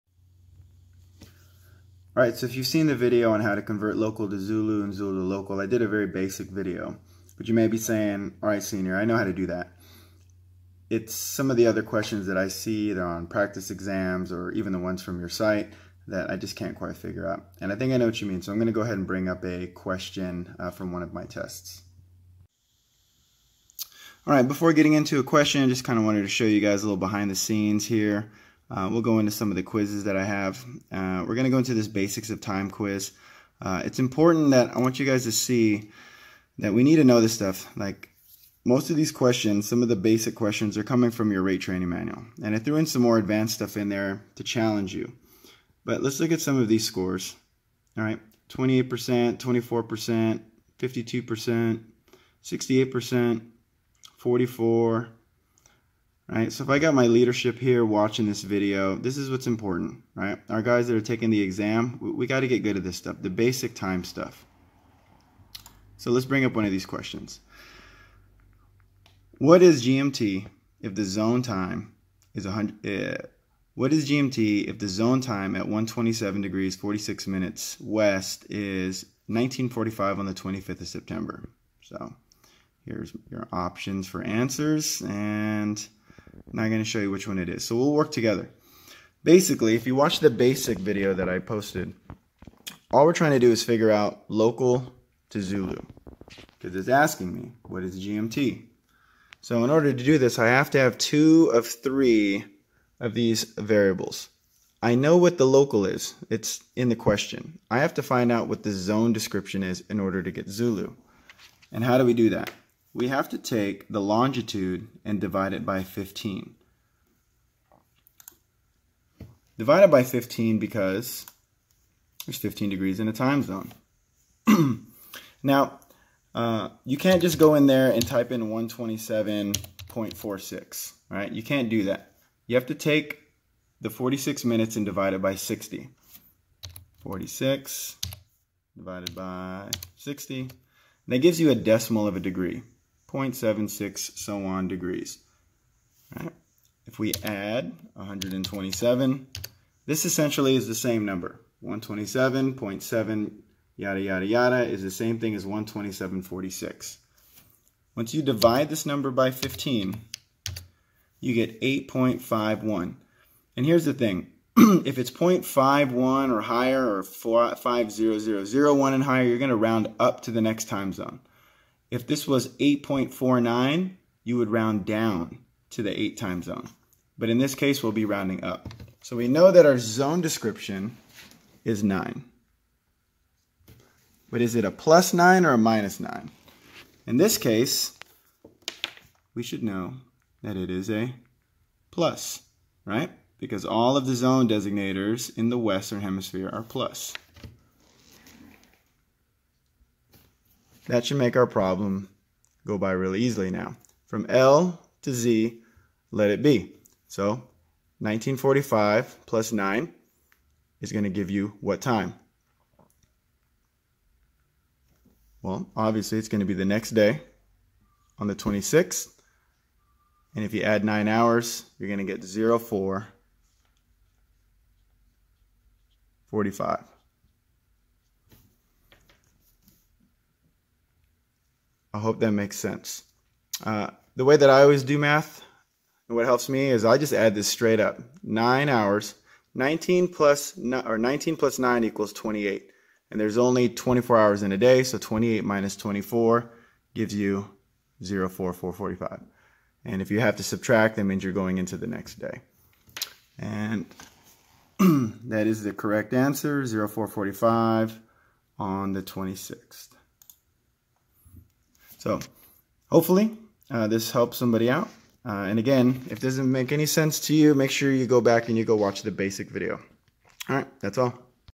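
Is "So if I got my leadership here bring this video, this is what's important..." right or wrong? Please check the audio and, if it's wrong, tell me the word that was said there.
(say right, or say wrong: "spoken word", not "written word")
wrong: "watching", not "bring".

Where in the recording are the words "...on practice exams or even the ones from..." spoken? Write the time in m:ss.
0:13.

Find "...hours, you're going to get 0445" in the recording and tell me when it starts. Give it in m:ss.
3:41.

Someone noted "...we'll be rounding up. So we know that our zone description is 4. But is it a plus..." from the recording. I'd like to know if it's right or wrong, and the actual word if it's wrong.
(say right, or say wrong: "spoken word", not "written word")
wrong: "9", not "4".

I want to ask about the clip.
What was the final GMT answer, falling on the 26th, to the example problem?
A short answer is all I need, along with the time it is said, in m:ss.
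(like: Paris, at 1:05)
0445, at 4:16.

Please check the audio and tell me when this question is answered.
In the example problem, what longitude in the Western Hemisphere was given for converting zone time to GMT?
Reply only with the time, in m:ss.
1:15.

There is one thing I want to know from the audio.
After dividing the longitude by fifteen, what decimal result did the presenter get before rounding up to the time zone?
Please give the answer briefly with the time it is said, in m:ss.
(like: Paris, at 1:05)
8.51, at 2:41.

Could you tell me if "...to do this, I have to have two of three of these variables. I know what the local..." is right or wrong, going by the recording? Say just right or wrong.
right.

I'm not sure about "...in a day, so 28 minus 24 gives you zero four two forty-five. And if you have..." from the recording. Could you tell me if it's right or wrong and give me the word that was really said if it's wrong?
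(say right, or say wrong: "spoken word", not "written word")
wrong: "four", not "two".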